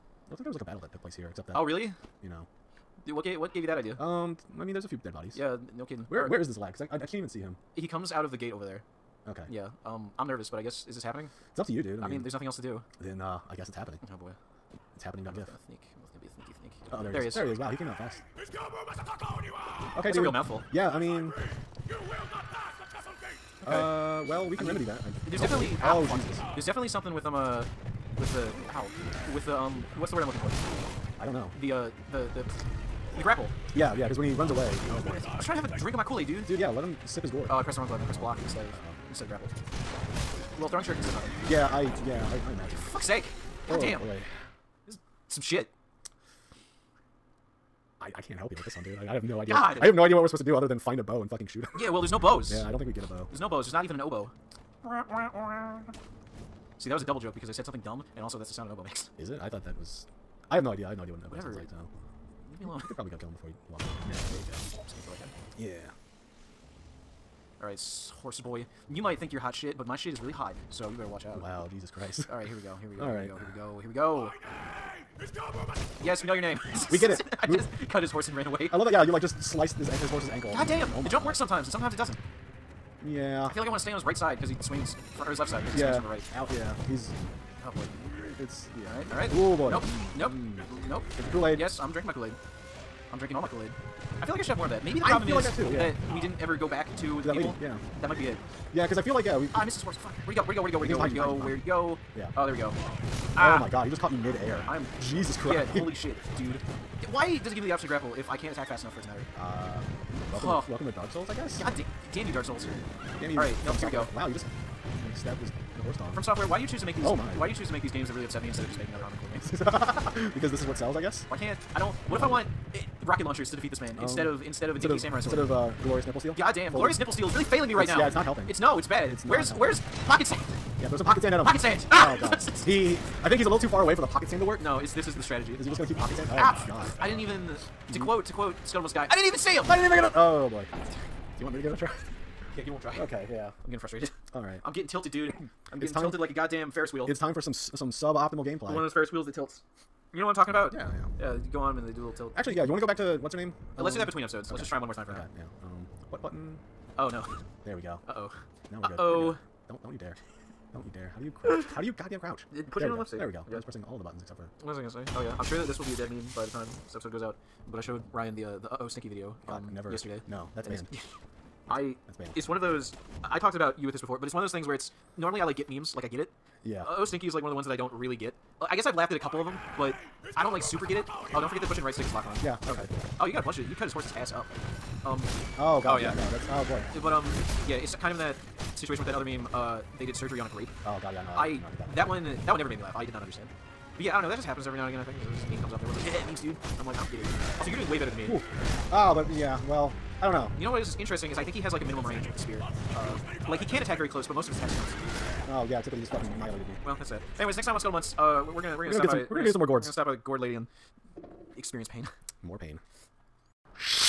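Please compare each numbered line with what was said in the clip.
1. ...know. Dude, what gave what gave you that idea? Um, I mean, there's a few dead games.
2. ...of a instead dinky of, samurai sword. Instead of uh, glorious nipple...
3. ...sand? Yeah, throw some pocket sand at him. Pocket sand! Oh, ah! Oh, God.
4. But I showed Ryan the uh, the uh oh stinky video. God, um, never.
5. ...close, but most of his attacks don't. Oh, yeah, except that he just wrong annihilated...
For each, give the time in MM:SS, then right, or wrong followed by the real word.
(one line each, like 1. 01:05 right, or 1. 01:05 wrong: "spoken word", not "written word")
1. 00:02 wrong: "bodies", not "games"
2. 02:04 right
3. 02:10 right
4. 02:47 right
5. 03:24 wrong: "fucking", not "wrong".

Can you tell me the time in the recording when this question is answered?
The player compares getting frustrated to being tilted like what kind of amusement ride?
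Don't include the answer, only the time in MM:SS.
02:26.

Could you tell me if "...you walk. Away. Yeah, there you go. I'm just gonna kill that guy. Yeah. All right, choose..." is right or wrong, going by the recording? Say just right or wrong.
wrong.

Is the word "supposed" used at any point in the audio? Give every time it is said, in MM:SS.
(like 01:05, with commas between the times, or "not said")
00:50.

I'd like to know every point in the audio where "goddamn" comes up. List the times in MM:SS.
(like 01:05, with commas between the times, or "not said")
02:26, 02:41.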